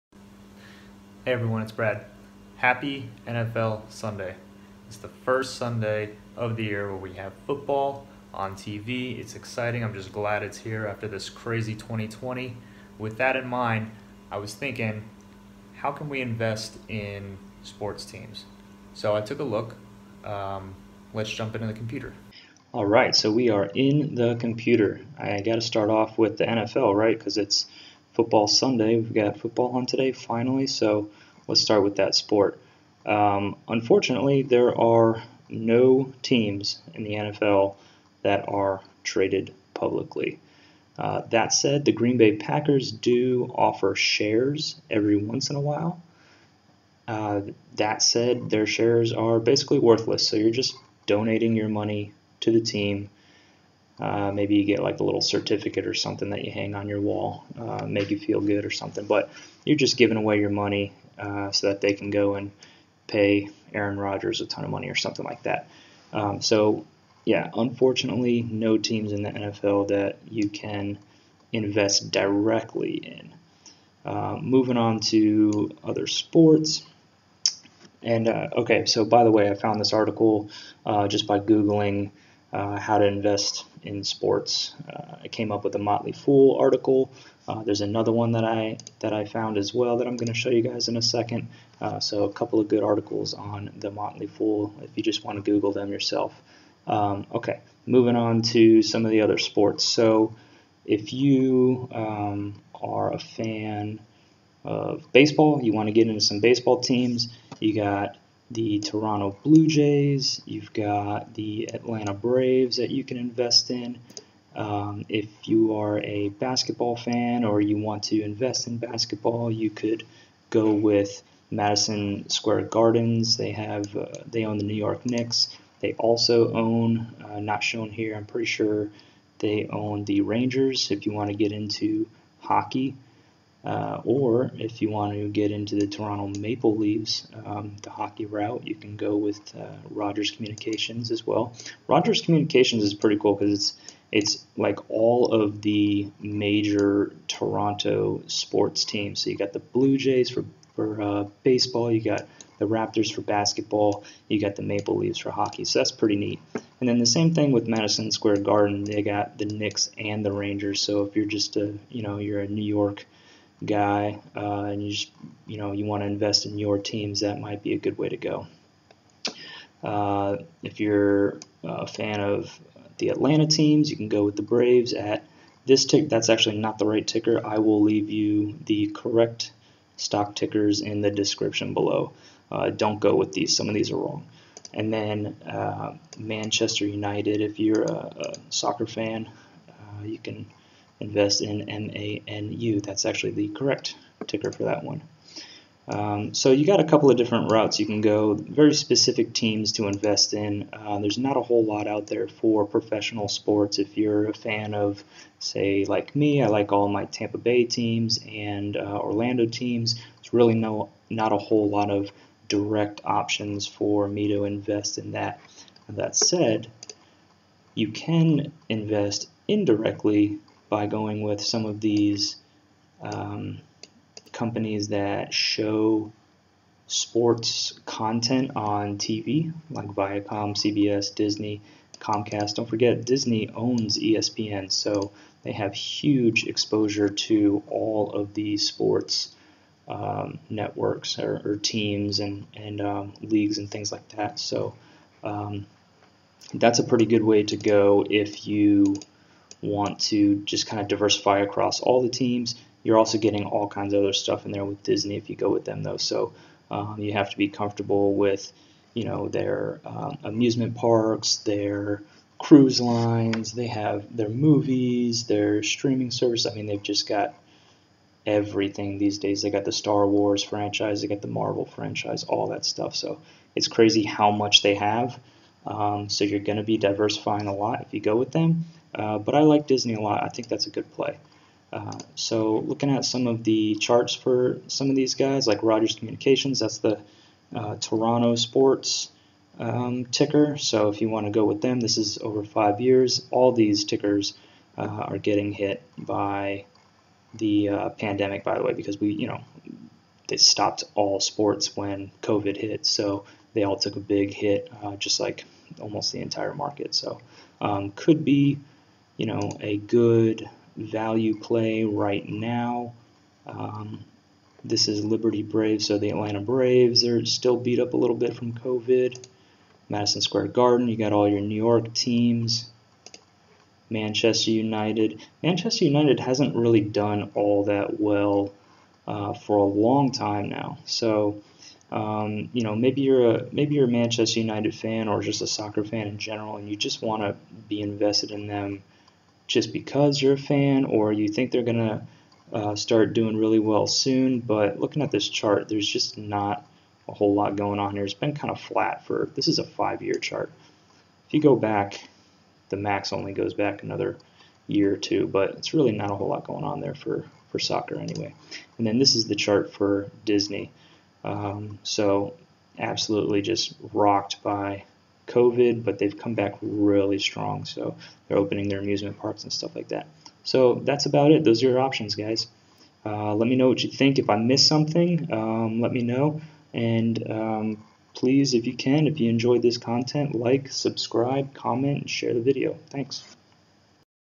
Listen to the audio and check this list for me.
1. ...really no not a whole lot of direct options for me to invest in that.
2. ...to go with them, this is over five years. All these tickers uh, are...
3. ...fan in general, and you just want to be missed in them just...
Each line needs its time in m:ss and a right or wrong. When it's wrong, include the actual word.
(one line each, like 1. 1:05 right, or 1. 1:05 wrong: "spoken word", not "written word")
1. 3:30 right
2. 4:51 right
3. 5:35 wrong: "invested", not "missed".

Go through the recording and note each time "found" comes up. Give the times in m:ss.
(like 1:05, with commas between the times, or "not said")
1:19, 1:29.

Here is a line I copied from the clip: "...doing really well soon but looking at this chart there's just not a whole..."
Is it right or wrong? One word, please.
right.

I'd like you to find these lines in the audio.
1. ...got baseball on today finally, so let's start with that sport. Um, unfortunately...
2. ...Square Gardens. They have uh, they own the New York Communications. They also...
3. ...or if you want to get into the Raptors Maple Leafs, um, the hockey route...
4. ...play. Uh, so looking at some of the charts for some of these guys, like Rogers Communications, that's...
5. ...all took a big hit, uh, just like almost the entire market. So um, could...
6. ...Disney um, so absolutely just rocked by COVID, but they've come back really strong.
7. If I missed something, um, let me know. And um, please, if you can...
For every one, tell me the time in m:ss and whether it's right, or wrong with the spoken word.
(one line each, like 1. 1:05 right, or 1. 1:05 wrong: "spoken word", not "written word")
1. 0:29 wrong: "football", not "baseball"
2. 2:02 wrong: "Knicks", not "Communications"
3. 2:14 wrong: "Toronto", not "Raptors"
4. 4:40 right
5. 5:03 right
6. 6:00 right
7. 6:14 right.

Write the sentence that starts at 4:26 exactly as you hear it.
I mean, they've just got everything these days.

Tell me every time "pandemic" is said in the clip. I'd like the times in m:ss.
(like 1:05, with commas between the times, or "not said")
4:57.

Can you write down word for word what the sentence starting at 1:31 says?
Uh, so a couple of good articles on the Motley Fool if you just want to Google them yourself.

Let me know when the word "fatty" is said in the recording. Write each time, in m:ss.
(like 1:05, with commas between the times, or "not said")
not said.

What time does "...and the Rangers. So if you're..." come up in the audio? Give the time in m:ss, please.
2:39.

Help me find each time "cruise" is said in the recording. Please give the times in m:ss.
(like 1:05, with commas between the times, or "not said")
4:22.